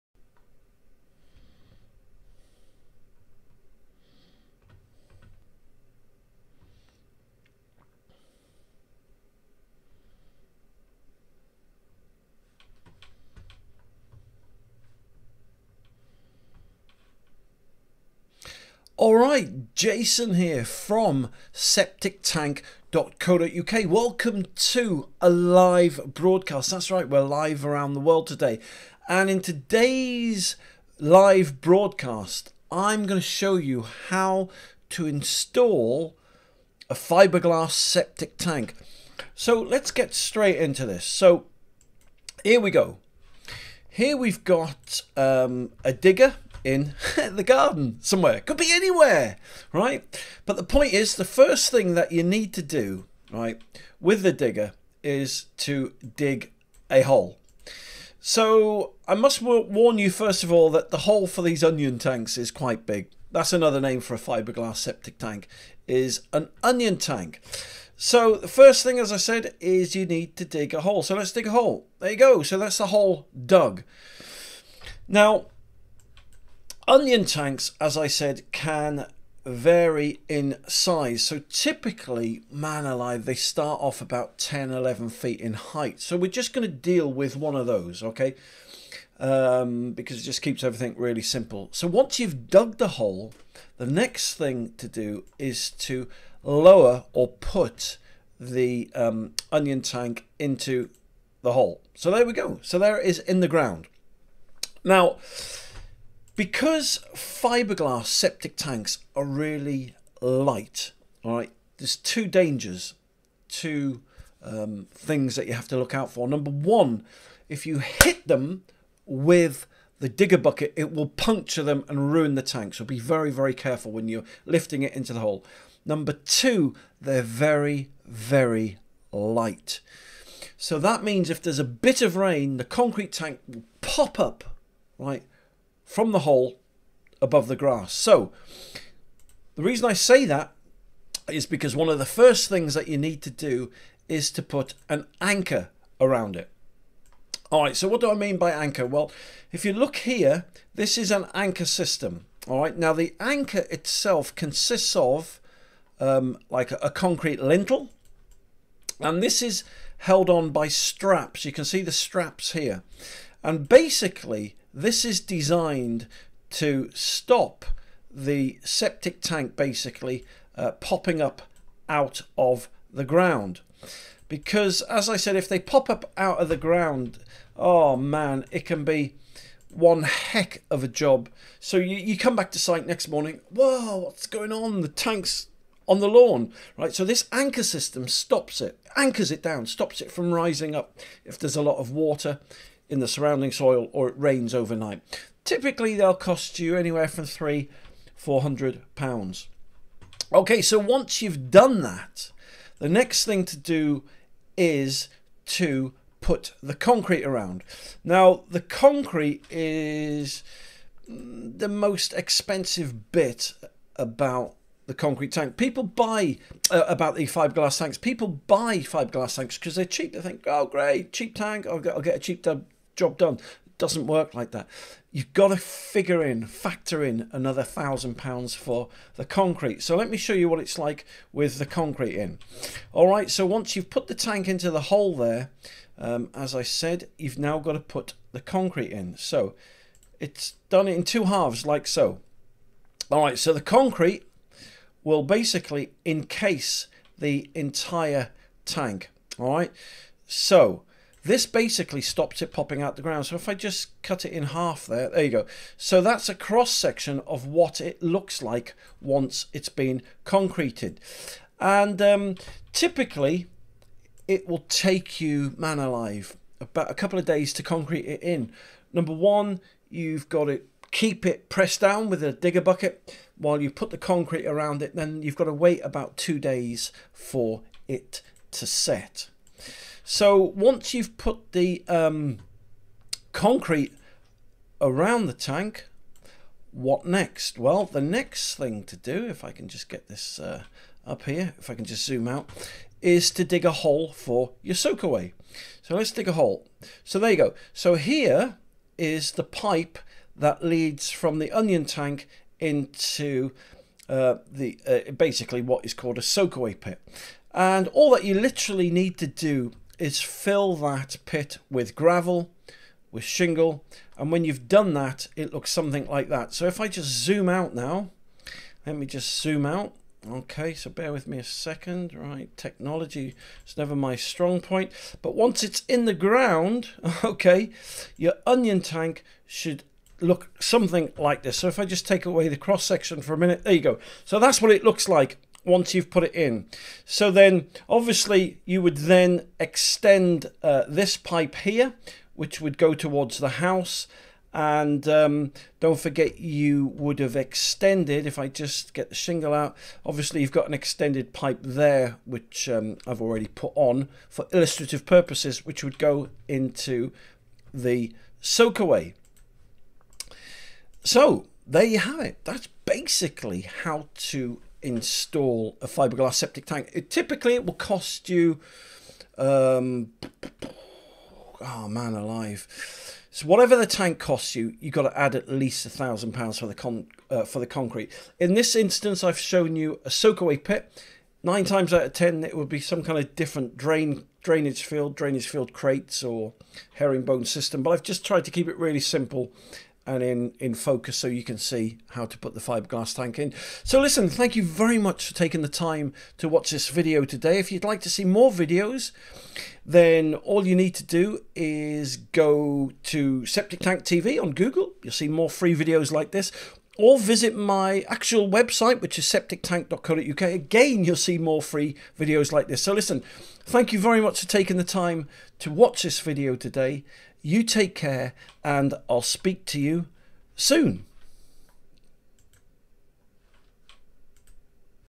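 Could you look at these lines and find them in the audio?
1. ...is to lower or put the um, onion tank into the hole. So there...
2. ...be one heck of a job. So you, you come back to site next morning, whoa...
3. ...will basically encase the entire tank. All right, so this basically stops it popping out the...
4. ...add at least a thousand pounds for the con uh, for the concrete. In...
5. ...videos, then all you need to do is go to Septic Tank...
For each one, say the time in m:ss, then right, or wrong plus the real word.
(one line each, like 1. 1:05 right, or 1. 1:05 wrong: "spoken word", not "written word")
1. 1:35 right
2. 2:58 right
3. 4:05 right
4. 6:15 right
5. 6:38 right.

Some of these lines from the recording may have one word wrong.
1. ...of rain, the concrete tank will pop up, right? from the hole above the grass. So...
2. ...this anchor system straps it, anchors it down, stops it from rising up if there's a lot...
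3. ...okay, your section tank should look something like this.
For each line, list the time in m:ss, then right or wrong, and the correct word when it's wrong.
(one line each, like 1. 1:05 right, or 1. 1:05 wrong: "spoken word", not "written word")
1. 2:12 right
2. 3:07 wrong: "stops", not "straps"
3. 5:27 wrong: "onion", not "section".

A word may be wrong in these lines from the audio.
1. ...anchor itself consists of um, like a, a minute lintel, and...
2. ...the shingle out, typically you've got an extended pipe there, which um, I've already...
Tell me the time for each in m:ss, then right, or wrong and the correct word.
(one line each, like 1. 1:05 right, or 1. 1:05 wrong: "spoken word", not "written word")
1. 2:33 wrong: "concrete", not "minute"
2. 5:49 wrong: "obviously", not "typically".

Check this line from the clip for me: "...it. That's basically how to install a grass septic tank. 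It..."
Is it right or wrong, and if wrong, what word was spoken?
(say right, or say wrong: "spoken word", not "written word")
wrong: "fiberglass", not "grass".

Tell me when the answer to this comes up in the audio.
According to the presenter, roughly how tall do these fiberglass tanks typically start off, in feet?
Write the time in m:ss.
1:24.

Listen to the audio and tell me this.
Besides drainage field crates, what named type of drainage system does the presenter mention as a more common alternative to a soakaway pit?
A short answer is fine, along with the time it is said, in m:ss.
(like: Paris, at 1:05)
Herringbone system, at 6:26.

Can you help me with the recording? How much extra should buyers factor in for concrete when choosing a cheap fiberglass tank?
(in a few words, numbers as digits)
£1,000.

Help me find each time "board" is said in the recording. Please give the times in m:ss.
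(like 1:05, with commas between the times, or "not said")
not said.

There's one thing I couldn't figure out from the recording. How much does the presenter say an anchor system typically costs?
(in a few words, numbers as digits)
£300-400.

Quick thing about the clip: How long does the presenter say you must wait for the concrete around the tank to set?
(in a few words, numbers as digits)
About two days.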